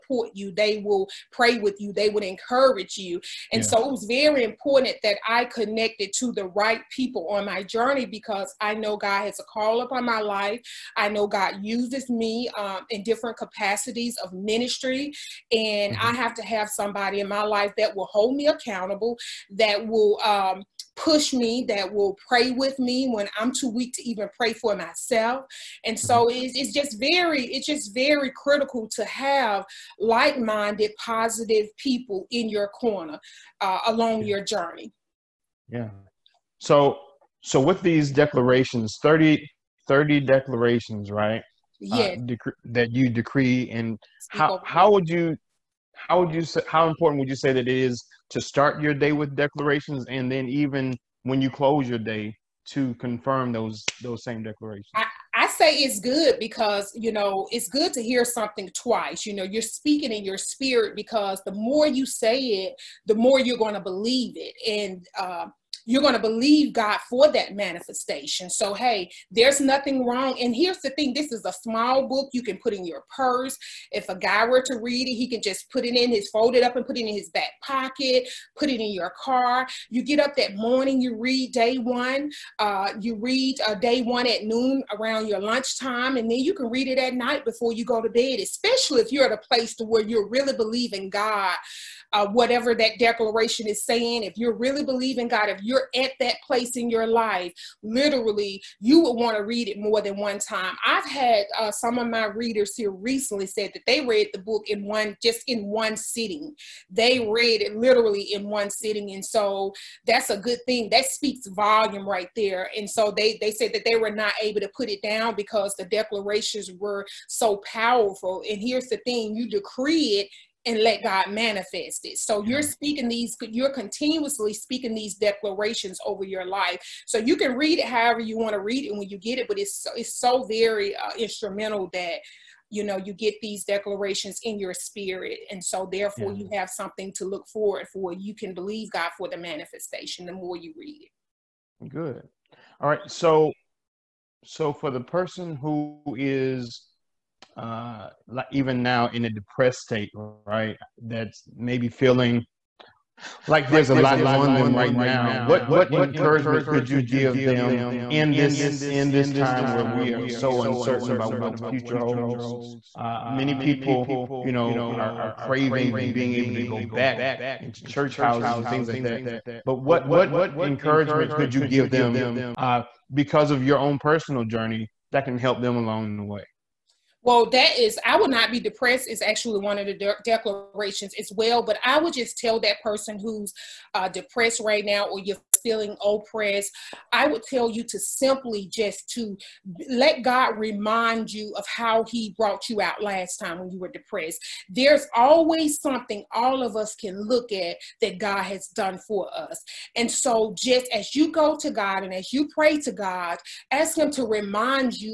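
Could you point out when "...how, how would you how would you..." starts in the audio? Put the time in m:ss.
0:44.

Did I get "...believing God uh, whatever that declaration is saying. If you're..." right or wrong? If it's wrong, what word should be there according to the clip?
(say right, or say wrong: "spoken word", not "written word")
right.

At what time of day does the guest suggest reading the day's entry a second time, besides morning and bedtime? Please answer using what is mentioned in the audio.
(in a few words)
Noon.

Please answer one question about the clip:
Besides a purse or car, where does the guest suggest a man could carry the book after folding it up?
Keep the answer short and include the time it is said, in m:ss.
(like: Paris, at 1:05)
His back pocket, at 1:17.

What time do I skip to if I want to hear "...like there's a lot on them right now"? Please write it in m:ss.
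2:33.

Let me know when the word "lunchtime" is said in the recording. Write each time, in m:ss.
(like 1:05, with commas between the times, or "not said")
1:25.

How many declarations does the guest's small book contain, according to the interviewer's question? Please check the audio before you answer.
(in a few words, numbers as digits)
30.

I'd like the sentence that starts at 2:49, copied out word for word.
But what what encouragement could you give them uh, because of your own personal journey that can help them along the way?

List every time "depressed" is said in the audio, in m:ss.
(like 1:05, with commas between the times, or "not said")
2:29, 2:58, 3:04, 3:13.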